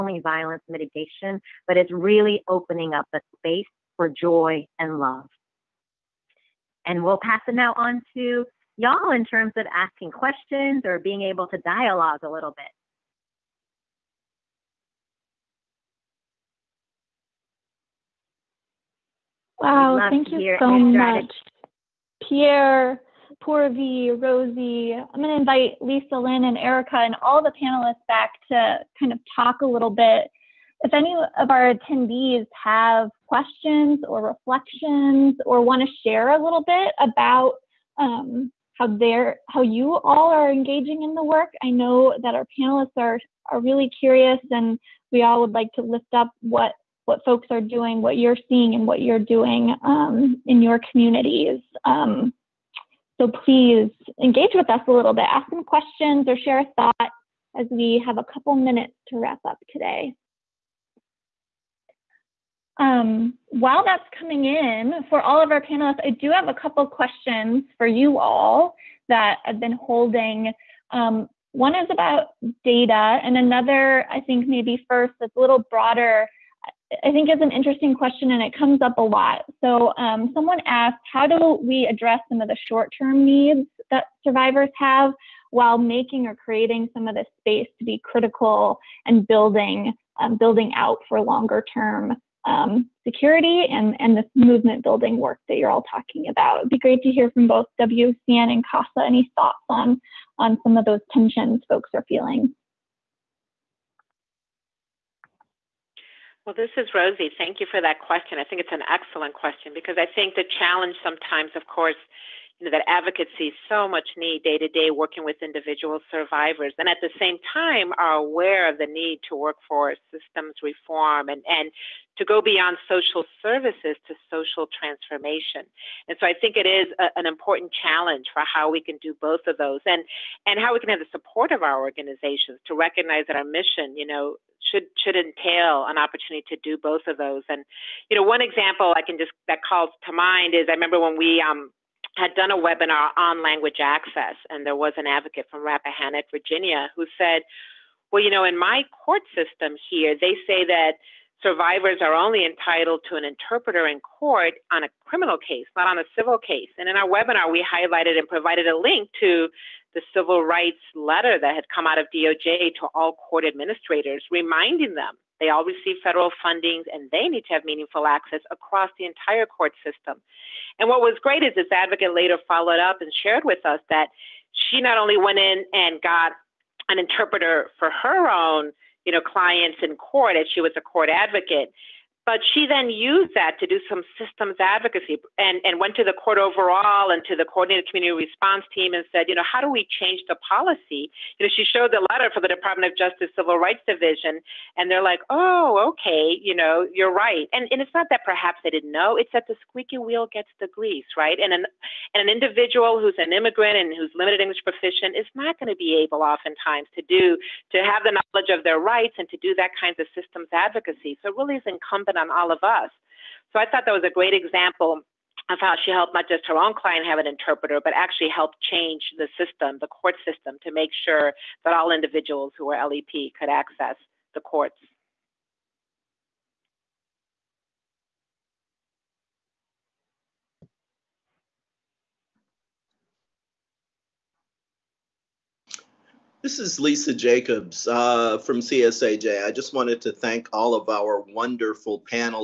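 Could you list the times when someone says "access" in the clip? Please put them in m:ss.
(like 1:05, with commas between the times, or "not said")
2:23, 2:48, 3:43.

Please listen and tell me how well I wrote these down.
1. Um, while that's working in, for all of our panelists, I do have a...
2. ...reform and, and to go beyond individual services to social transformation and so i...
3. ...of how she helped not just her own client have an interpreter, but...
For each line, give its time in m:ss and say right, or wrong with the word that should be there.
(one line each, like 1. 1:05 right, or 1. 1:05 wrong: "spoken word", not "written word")
1. 1:02 wrong: "coming", not "working"
2. 2:00 wrong: "social", not "individual"
3. 3:35 right.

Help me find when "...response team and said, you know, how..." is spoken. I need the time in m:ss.
3:08.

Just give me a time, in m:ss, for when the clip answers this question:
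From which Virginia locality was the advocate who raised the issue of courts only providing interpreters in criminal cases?
2:25.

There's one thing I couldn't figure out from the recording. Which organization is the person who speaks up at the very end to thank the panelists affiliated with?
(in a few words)
CSAJ.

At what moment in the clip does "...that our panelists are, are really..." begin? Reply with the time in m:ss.
0:42.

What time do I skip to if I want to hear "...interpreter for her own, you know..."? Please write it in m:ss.
2:56.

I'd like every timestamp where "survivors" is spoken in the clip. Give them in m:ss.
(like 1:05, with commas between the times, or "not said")
1:24, 1:56, 2:31.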